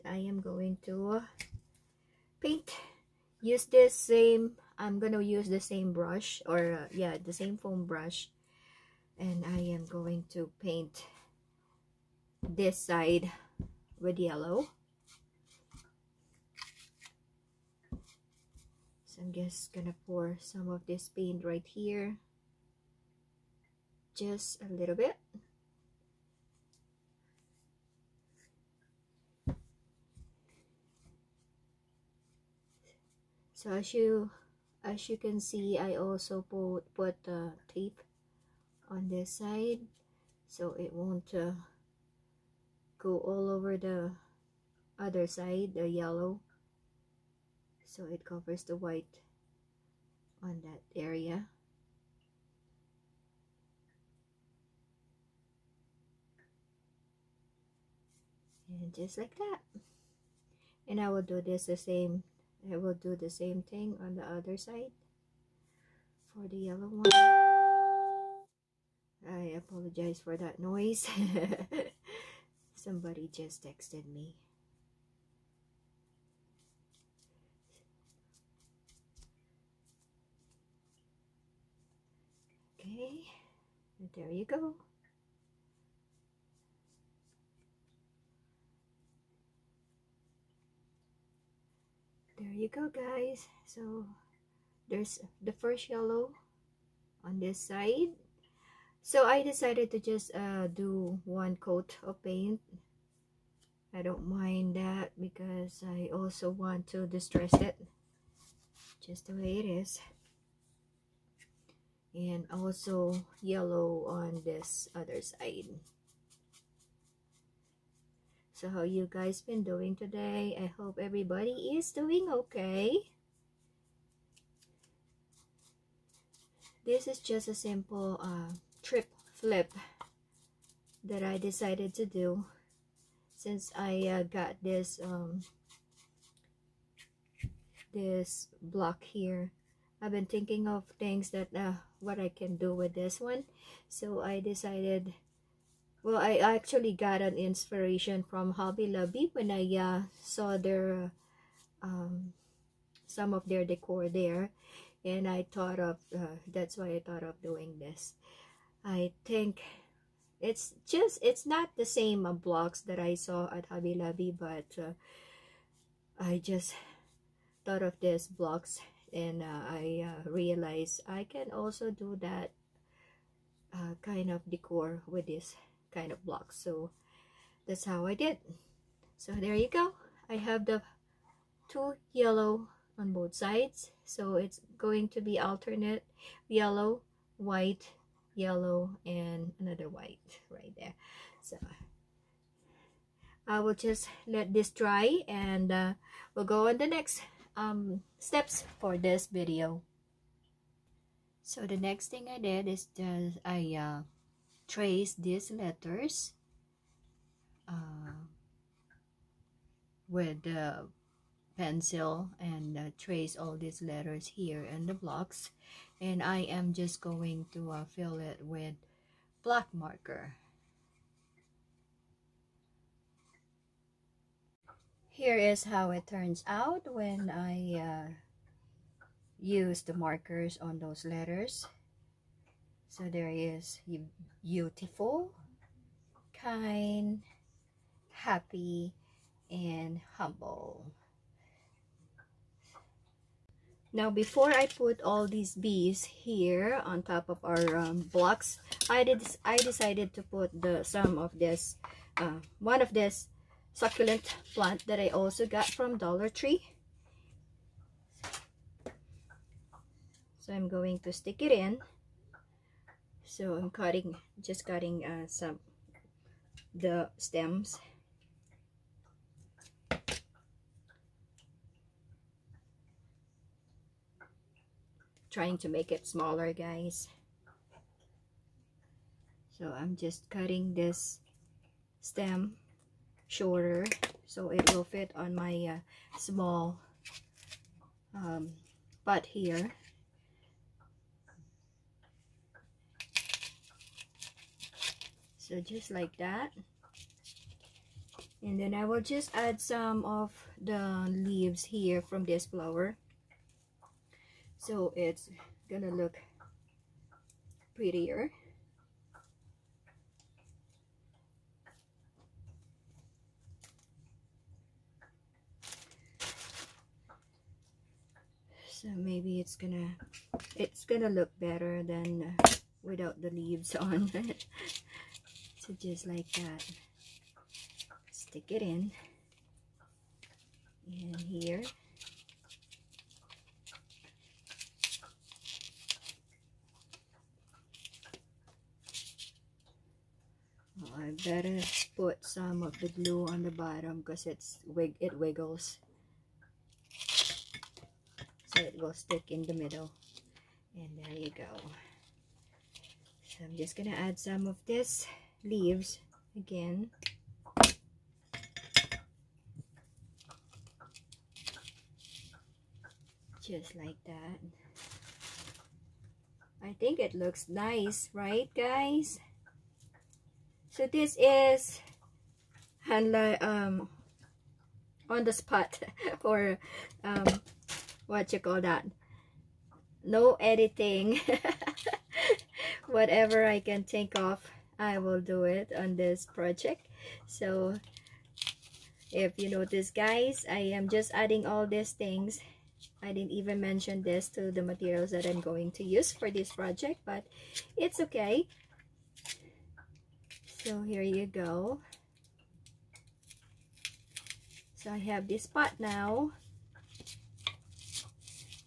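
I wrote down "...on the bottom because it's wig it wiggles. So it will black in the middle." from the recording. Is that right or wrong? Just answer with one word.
wrong.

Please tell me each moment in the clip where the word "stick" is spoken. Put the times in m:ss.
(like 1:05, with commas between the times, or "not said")
4:21, 5:28, 5:48.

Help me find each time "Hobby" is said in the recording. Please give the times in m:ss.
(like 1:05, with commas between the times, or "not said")
2:28, 2:43.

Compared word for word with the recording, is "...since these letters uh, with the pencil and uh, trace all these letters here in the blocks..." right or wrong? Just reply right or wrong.
wrong.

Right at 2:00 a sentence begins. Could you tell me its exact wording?
I hope everybody is doing okay.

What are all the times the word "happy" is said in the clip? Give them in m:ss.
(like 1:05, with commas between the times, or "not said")
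3:58.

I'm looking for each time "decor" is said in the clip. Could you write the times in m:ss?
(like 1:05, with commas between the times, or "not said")
2:33, 2:54.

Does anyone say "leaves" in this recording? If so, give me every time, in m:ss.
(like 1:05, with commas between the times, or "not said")
5:01, 5:23, 5:55.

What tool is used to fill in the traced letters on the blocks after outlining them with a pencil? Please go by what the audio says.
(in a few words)
Black marker.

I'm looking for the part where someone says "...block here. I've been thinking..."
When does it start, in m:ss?
2:18.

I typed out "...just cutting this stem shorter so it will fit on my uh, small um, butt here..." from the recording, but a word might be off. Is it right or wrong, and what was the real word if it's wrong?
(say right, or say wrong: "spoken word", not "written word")
right.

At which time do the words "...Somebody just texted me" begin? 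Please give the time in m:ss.
1:12.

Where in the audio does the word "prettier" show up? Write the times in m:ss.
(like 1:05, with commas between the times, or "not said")
5:07.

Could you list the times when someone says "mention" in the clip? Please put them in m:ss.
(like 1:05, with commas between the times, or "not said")
6:33.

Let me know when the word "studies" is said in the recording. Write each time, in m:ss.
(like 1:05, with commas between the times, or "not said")
not said.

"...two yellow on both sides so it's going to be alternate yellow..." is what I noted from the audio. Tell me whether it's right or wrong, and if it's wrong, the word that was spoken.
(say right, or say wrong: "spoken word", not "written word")
right.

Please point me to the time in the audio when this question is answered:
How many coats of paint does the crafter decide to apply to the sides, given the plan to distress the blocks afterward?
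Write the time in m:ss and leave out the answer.
1:41.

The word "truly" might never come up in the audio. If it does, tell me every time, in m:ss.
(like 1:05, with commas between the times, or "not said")
not said.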